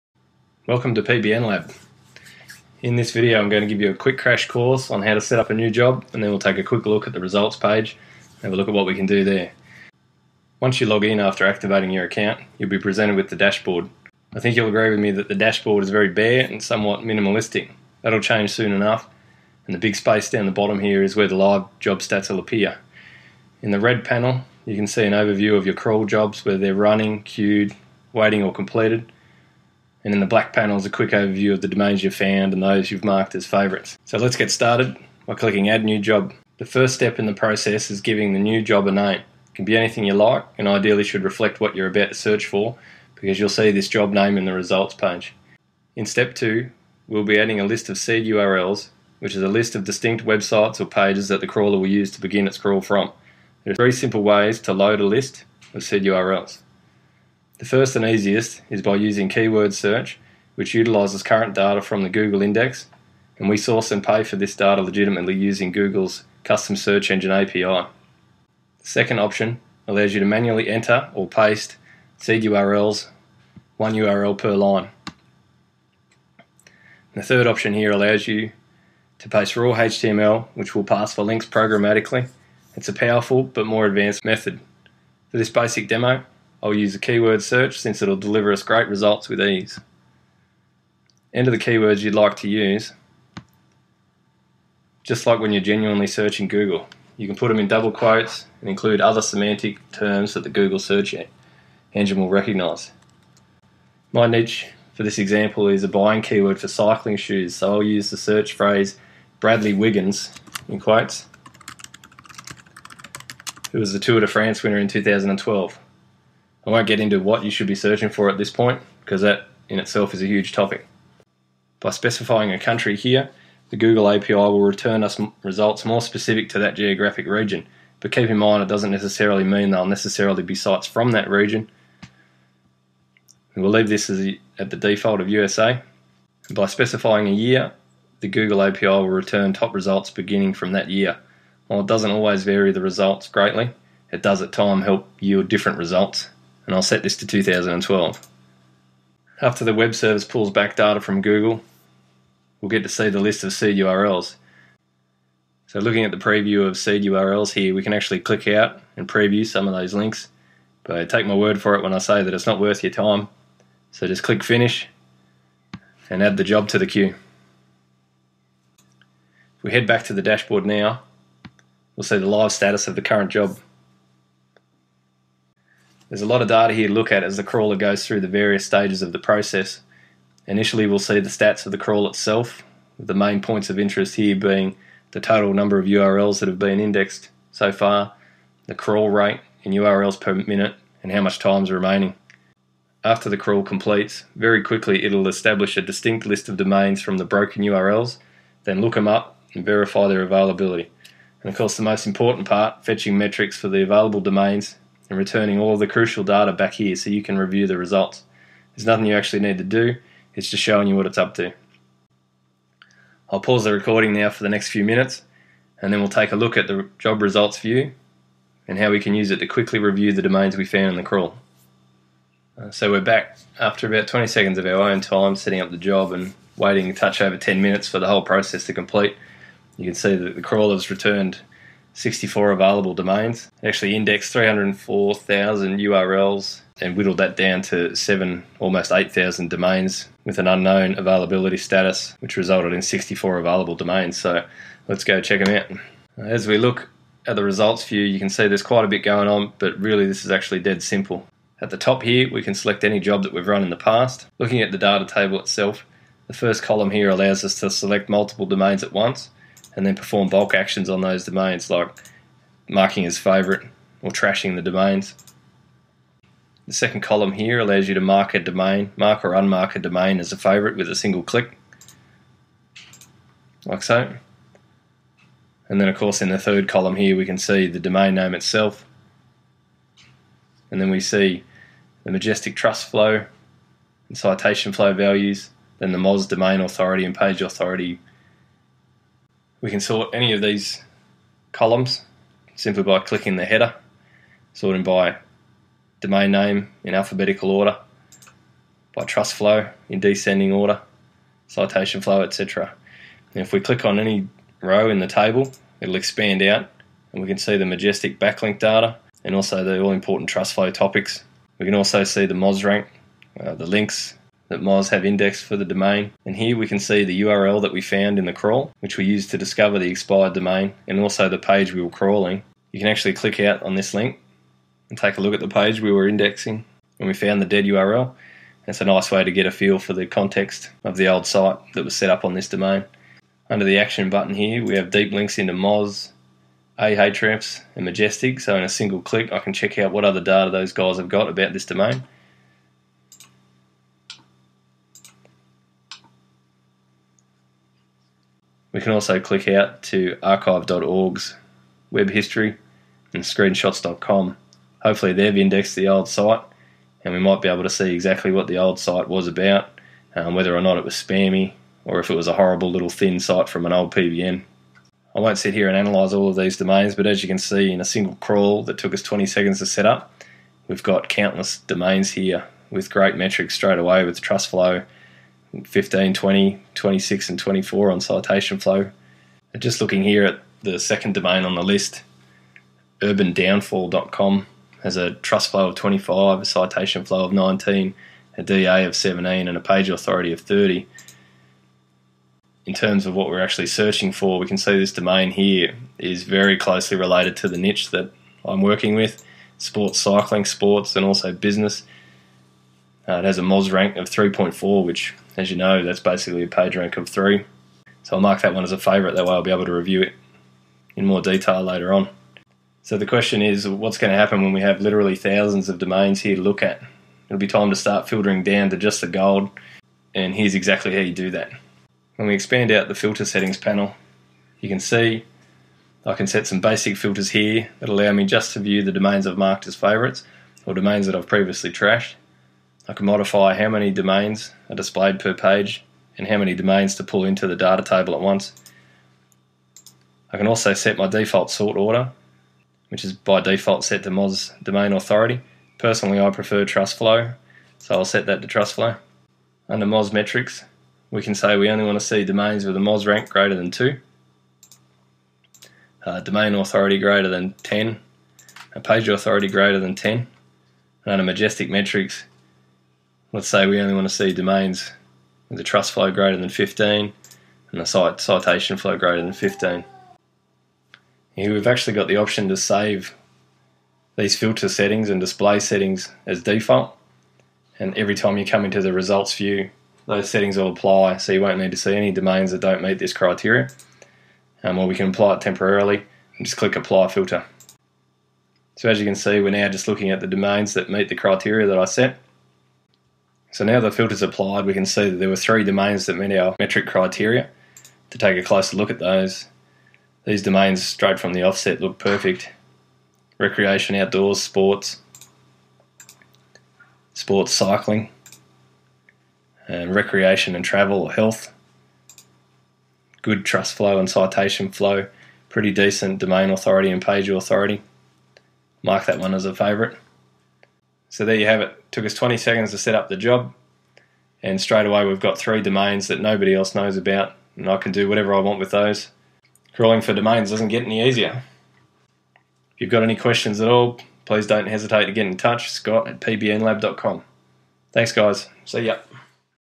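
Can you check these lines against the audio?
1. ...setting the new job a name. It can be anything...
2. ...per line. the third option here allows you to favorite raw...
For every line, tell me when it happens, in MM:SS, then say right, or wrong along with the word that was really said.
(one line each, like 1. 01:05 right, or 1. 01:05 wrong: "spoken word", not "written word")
1. 00:38 wrong: "giving", not "setting"
2. 01:14 wrong: "paste", not "favorite".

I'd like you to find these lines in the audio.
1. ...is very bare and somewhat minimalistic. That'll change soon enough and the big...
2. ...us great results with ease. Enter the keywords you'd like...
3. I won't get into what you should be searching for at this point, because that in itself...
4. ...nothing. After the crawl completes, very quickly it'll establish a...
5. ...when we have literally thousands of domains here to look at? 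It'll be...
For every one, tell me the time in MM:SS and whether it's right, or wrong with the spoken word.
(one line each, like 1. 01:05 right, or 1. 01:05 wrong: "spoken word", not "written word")
1. 00:15 right
2. 01:28 right
3. 01:56 right
4. 03:11 wrong: "remaining", not "nothing"
5. 06:54 right.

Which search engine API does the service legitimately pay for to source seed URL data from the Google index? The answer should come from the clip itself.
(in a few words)
Google's custom search engine API.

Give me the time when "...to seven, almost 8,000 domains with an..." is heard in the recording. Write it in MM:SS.
03:57.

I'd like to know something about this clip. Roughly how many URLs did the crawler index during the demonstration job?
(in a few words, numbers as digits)
304,000.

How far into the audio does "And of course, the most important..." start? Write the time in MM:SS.
03:21.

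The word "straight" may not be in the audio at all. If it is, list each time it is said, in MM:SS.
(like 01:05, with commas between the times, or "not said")
06:13, 08:20, 08:44.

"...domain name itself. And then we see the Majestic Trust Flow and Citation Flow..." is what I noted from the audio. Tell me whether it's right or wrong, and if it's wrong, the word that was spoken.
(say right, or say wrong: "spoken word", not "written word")
right.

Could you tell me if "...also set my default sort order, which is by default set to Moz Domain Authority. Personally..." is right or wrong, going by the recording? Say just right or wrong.
right.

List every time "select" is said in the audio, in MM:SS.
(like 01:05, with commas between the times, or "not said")
04:12, 04:17.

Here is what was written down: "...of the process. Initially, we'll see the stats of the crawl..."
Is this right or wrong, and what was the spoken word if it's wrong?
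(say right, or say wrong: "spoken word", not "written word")
right.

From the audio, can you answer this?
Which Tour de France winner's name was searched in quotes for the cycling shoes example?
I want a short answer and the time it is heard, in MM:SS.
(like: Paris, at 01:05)
Bradley Wiggins, at 01:49.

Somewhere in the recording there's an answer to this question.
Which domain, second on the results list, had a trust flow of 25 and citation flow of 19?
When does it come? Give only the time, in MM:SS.
06:23.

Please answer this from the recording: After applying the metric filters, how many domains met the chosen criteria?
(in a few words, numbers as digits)
3.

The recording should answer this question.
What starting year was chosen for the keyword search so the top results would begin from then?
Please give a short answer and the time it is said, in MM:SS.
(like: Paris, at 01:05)
2012, at 02:26.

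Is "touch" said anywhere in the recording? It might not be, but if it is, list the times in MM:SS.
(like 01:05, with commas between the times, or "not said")
03:46, 08:55.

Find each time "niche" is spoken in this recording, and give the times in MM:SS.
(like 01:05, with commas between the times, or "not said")
01:44, 06:37.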